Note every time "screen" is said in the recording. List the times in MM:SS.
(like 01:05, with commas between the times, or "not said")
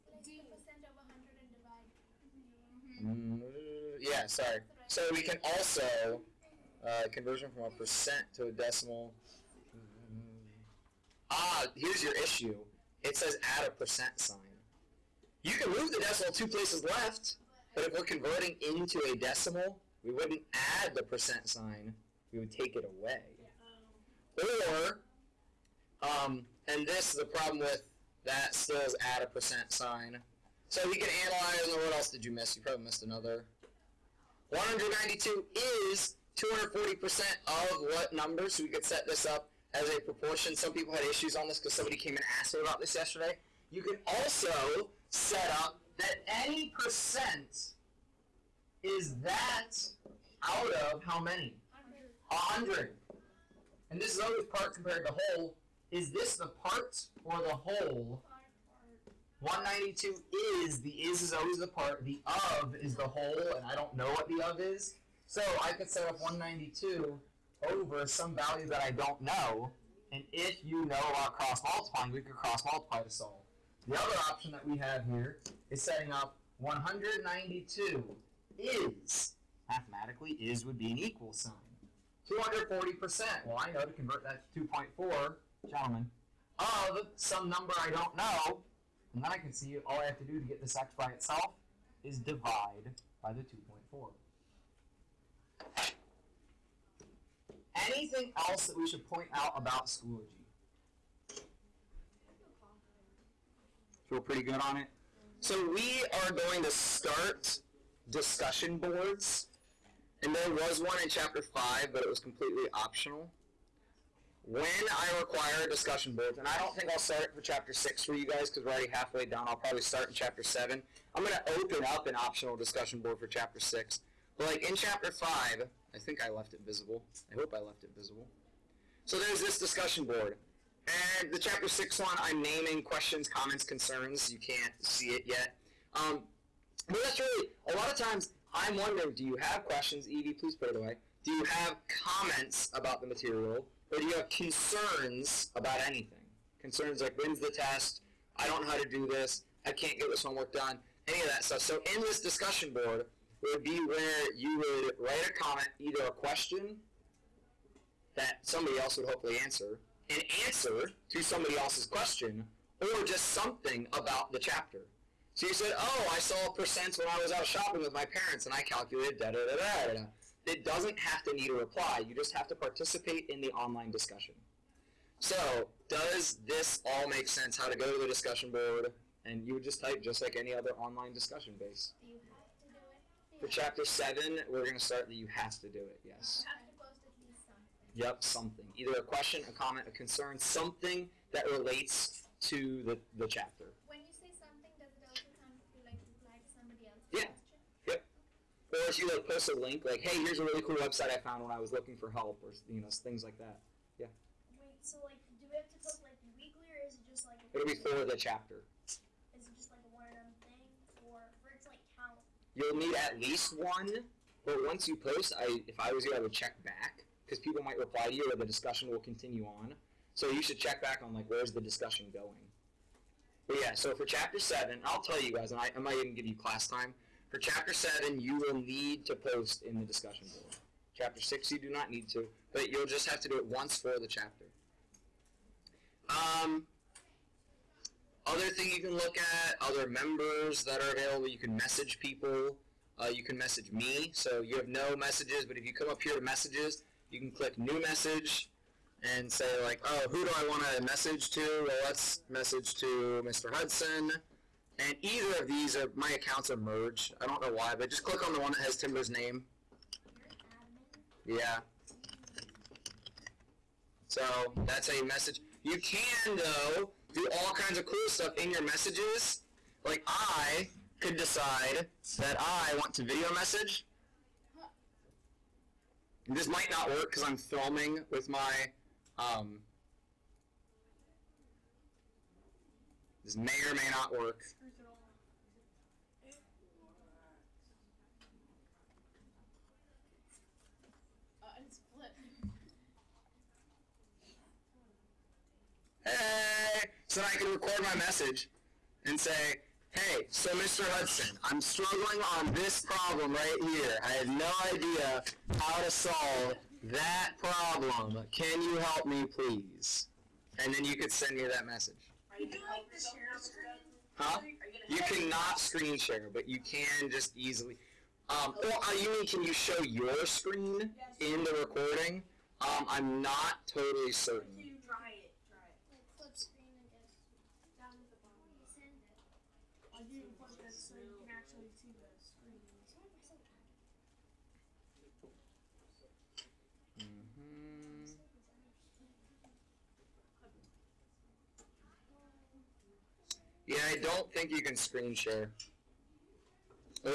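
05:15, 05:20, 05:44.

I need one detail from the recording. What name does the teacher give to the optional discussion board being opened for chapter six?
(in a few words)
questions, comments, concerns.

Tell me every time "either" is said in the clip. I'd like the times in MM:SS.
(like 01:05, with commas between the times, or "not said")
02:35, 03:08, 04:15.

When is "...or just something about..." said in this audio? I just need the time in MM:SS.
02:42.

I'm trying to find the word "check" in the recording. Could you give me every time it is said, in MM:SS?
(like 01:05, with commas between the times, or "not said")
03:36, 03:40.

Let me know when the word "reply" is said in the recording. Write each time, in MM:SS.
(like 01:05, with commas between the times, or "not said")
02:51, 03:16, 03:37.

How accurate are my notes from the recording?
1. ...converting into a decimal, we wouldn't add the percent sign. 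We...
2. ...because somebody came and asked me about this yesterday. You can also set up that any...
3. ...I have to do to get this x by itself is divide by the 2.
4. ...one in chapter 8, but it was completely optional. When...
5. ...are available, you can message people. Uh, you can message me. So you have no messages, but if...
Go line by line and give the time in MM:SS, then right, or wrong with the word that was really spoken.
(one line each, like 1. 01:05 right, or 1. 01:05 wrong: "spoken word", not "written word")
1. 00:18 right
2. 00:41 right
3. 01:30 right
4. 01:50 wrong: "5", not "8"
5. 04:00 right.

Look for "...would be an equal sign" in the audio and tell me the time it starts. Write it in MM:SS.
01:20.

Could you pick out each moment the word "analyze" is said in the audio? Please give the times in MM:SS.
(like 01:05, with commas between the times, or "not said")
00:31.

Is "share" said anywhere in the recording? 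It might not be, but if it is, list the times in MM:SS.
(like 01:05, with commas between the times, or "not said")
05:15, 05:45.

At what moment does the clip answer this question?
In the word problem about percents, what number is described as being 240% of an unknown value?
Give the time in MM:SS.
00:34.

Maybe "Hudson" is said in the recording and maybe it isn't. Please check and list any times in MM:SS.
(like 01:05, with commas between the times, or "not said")
04:13, 05:00.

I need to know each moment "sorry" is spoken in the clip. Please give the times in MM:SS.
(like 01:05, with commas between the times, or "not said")
00:04.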